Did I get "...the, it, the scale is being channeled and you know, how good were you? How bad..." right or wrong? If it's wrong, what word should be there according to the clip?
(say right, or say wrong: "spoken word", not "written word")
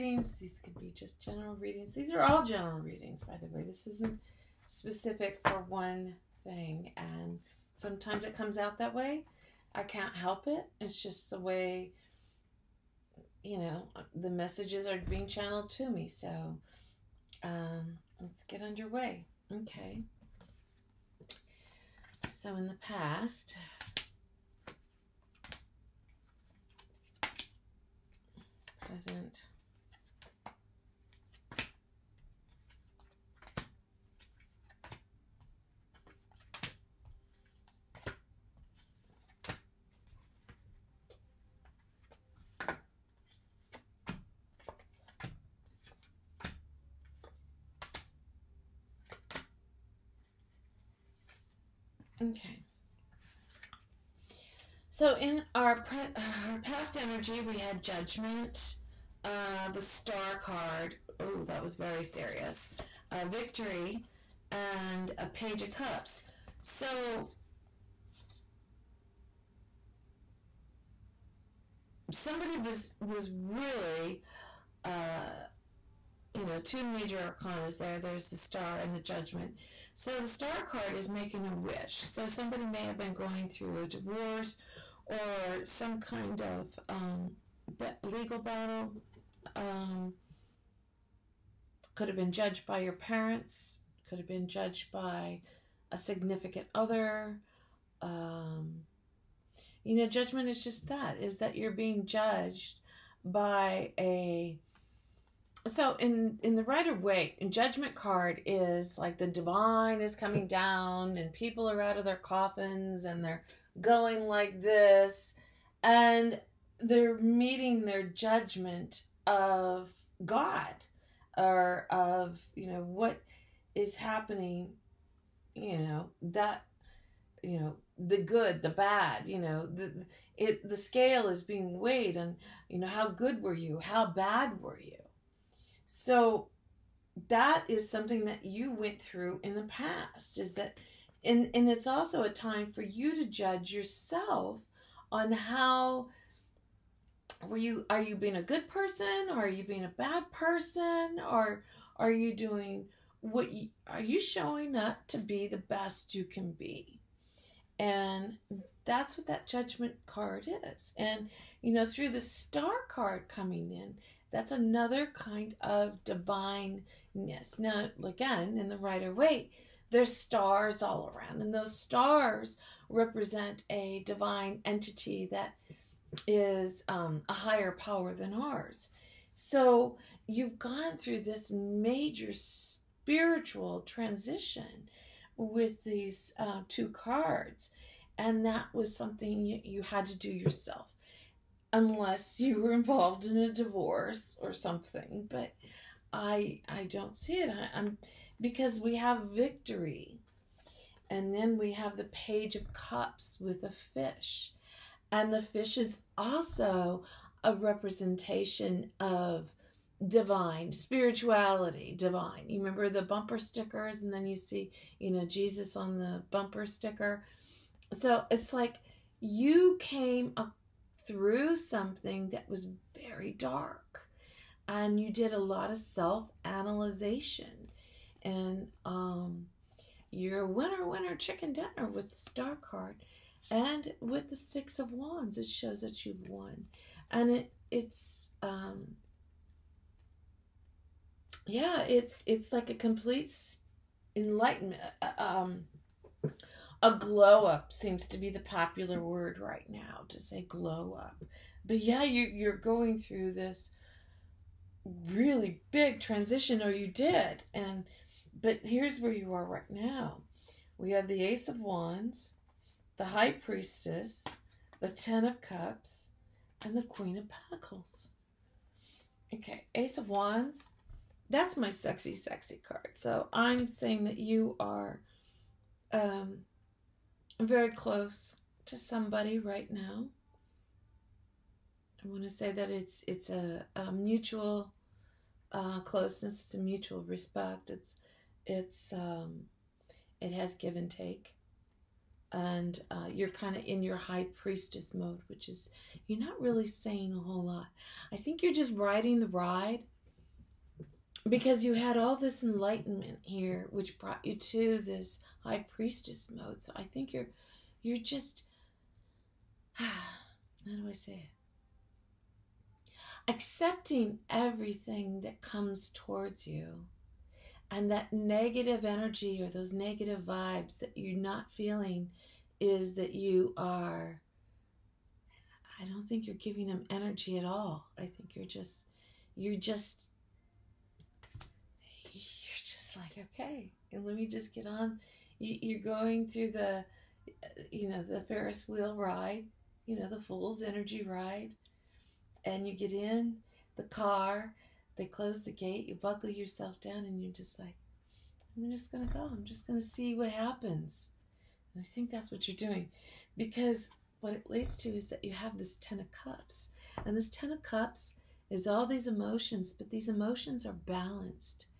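wrong: "weighed", not "channeled".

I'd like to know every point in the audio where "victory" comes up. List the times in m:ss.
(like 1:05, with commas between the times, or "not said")
1:03, 3:19.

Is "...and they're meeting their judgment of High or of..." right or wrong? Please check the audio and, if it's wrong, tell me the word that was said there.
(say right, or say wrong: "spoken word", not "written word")
wrong: "God", not "High".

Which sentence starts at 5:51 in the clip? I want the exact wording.
And I think that's what you're doing because what it leads to is that you have this Ten of Cups.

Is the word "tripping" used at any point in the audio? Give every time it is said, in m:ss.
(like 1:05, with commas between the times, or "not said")
not said.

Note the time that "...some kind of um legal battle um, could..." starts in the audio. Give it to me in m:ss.
1:25.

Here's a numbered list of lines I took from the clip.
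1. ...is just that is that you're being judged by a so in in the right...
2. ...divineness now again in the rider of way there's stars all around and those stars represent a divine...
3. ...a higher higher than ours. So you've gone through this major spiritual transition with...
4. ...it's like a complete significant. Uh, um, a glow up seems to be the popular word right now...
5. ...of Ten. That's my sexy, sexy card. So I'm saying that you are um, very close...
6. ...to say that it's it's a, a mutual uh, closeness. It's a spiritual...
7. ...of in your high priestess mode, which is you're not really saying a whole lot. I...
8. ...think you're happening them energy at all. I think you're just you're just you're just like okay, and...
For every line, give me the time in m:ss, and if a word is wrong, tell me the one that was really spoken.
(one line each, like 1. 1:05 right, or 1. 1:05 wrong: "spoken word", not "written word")
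1. 1:40 right
2. 2:46 right
3. 2:57 wrong: "power", not "higher"
4. 4:02 wrong: "enlightenment", not "significant"
5. 4:29 wrong: "Wands", not "Ten"
6. 4:42 wrong: "mutual", not "spiritual"
7. 4:53 right
8. 5:26 wrong: "giving", not "happening".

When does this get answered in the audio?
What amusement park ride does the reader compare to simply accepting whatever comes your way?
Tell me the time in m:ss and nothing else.
5:38.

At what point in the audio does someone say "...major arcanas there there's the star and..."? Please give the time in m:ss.
1:16.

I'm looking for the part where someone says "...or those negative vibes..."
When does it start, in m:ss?
5:19.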